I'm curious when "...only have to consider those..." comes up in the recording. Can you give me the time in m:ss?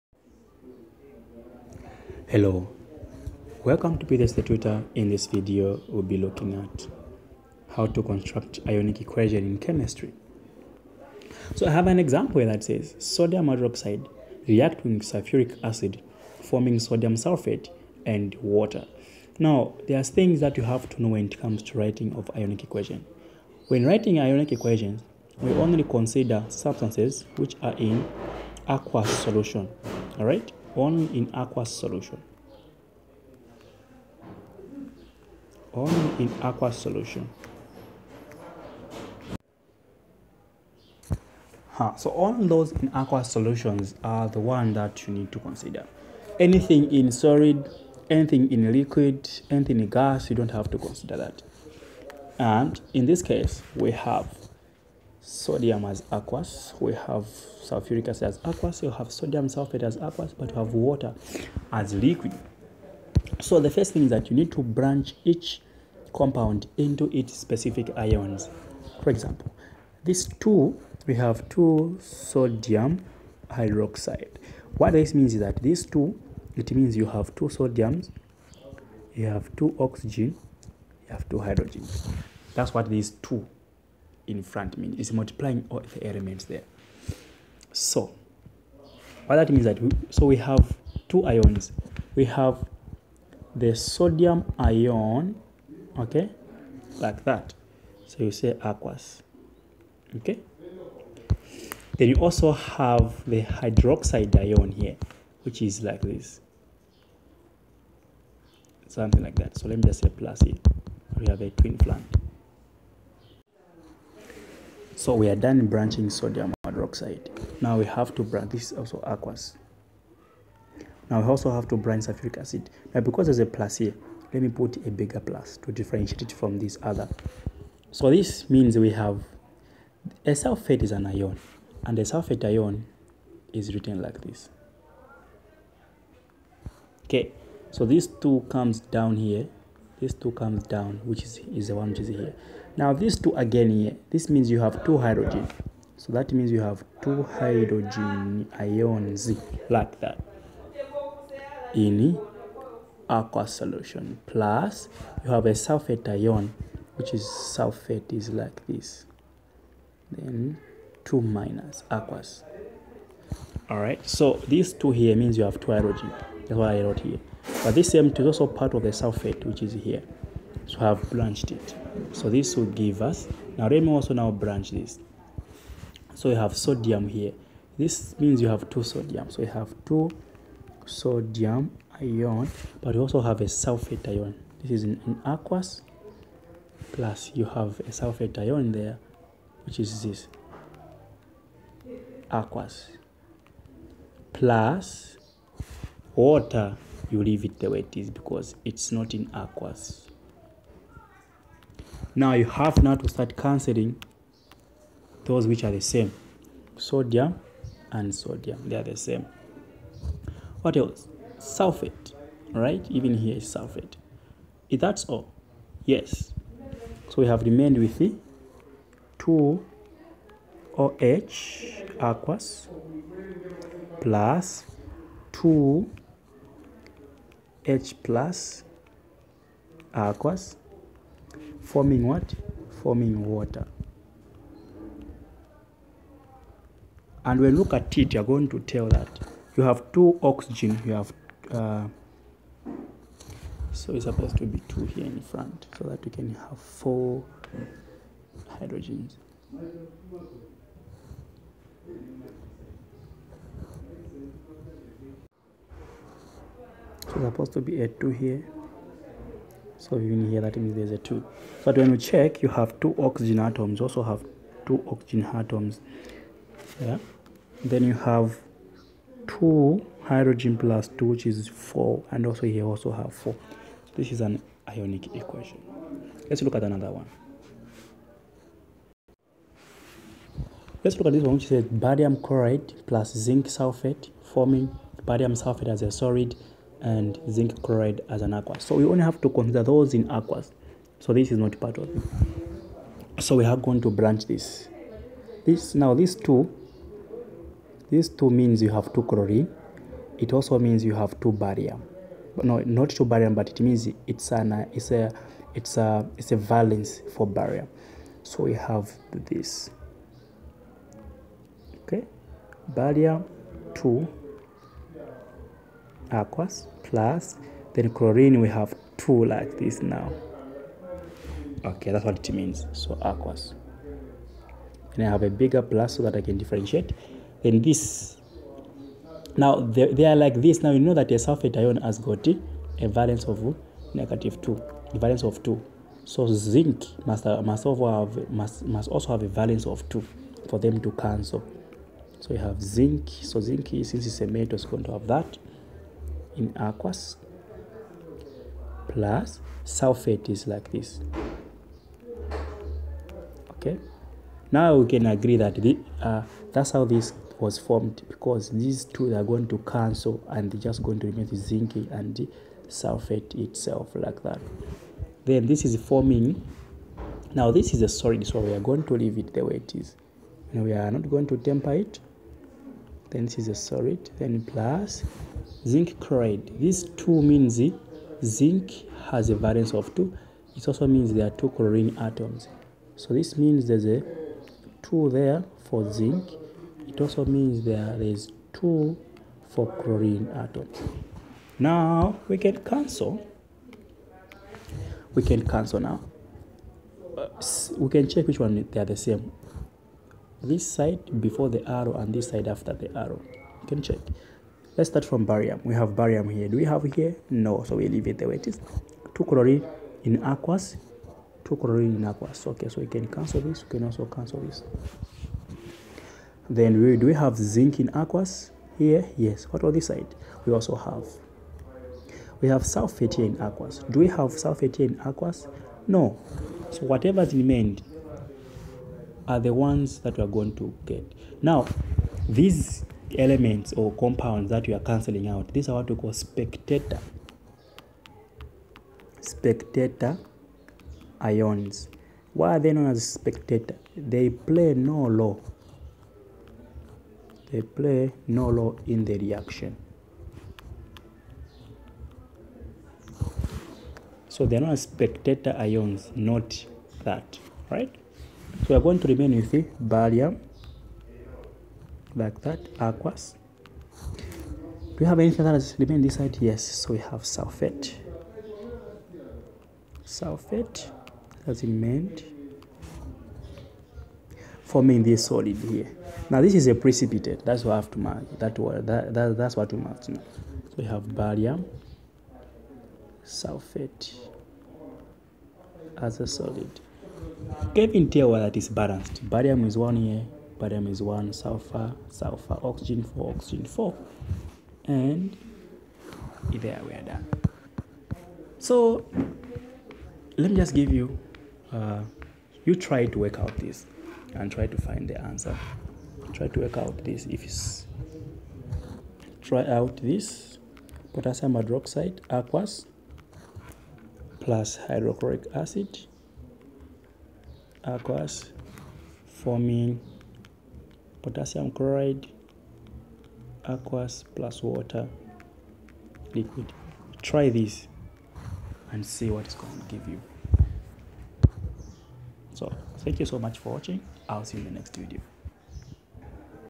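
4:48.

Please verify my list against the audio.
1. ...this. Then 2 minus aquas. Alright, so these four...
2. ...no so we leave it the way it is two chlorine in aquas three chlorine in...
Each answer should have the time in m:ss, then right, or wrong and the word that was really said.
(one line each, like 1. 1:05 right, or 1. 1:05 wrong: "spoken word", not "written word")
1. 2:38 wrong: "two", not "four"
2. 6:47 wrong: "two", not "three".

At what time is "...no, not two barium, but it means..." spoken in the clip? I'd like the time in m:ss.
5:02.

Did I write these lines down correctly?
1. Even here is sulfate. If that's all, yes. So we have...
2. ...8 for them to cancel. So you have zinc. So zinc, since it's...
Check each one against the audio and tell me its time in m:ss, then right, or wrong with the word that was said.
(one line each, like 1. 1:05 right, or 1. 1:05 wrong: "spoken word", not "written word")
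1. 3:32 right
2. 5:39 wrong: "2", not "8".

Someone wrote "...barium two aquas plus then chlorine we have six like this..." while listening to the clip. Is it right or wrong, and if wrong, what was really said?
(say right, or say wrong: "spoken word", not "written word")
wrong: "two", not "six".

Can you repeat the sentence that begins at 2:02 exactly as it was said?
Now because there's a plus here, let me put a bigger plus to differentiate it from this other.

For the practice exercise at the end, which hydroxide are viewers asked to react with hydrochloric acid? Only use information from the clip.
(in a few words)
Potassium hydroxide.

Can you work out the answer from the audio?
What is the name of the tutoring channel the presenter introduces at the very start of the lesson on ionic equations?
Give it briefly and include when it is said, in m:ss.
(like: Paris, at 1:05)
PVS the Tutor, at 0:04.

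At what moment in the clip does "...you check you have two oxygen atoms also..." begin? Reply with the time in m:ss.
4:21.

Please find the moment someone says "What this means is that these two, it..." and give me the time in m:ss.
1:14.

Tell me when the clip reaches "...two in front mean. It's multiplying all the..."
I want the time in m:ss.
1:23.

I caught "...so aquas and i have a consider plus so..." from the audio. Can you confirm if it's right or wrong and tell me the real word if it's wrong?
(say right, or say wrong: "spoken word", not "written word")
wrong: "bigger", not "consider".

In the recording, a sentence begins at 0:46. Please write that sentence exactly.
Anything in solid, anything in liquid, anything in gas, you don't have to consider that.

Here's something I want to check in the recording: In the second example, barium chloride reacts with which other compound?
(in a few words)
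Zinc sulfate.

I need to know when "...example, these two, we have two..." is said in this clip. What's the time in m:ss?
1:09.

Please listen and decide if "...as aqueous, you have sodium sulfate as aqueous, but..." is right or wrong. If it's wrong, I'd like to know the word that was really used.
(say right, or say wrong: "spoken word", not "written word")
right.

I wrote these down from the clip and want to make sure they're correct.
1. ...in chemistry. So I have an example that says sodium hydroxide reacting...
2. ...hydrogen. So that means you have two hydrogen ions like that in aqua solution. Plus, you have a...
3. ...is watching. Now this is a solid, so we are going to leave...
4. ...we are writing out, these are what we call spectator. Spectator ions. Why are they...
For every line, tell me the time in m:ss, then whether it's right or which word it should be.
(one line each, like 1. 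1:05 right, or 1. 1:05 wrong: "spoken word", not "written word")
1. 0:09 right
2. 2:24 right
3. 6:05 wrong: "forming", not "watching"
4. 7:14 wrong: "cancelling", not "writing".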